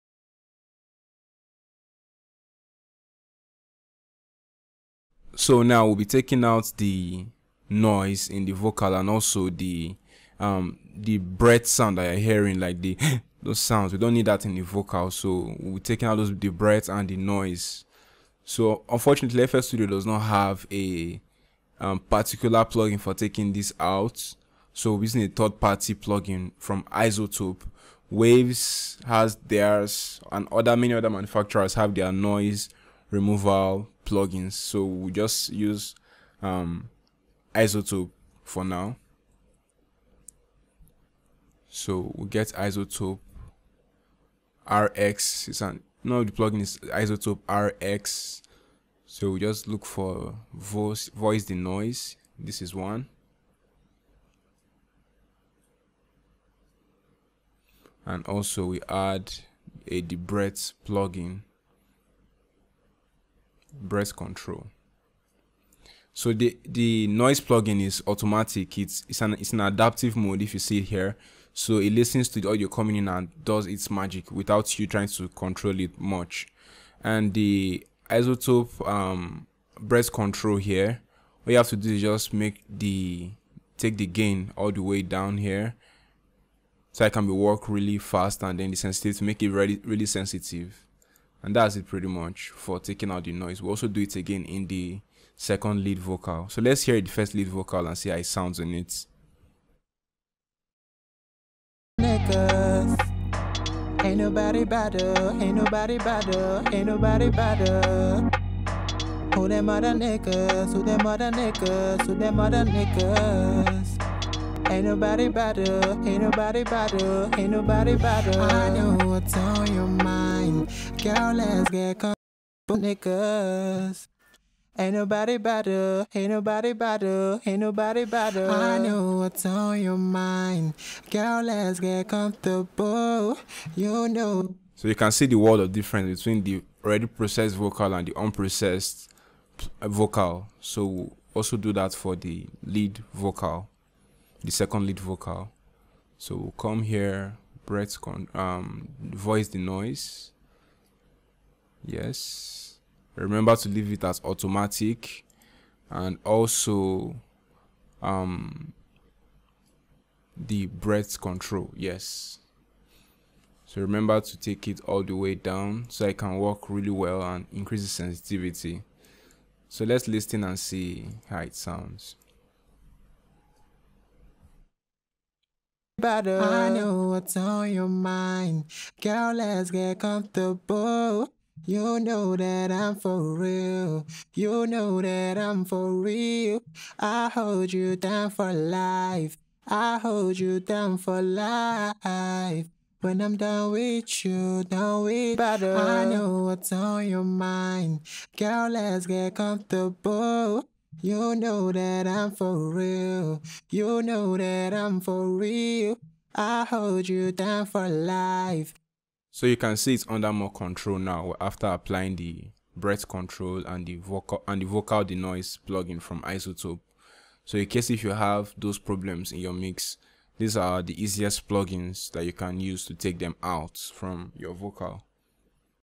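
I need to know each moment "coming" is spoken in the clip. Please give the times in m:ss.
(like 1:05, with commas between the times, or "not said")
1:12.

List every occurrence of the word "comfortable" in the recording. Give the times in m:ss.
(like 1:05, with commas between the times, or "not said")
2:01, 2:12, 2:59, 3:19.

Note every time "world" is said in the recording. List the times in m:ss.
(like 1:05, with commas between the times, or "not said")
2:15.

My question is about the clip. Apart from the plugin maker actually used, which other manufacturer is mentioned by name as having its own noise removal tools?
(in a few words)
Waves.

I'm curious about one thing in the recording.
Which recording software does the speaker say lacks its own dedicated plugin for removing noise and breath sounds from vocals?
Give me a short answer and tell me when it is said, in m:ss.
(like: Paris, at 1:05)
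FL Studio, at 0:19.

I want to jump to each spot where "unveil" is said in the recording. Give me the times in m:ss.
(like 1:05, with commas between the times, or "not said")
not said.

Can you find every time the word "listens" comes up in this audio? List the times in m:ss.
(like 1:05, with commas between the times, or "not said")
1:11, 2:50.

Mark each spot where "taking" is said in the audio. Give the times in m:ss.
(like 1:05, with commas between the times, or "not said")
0:06, 0:15, 0:23, 1:32.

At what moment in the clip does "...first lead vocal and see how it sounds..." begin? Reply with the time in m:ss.
1:37.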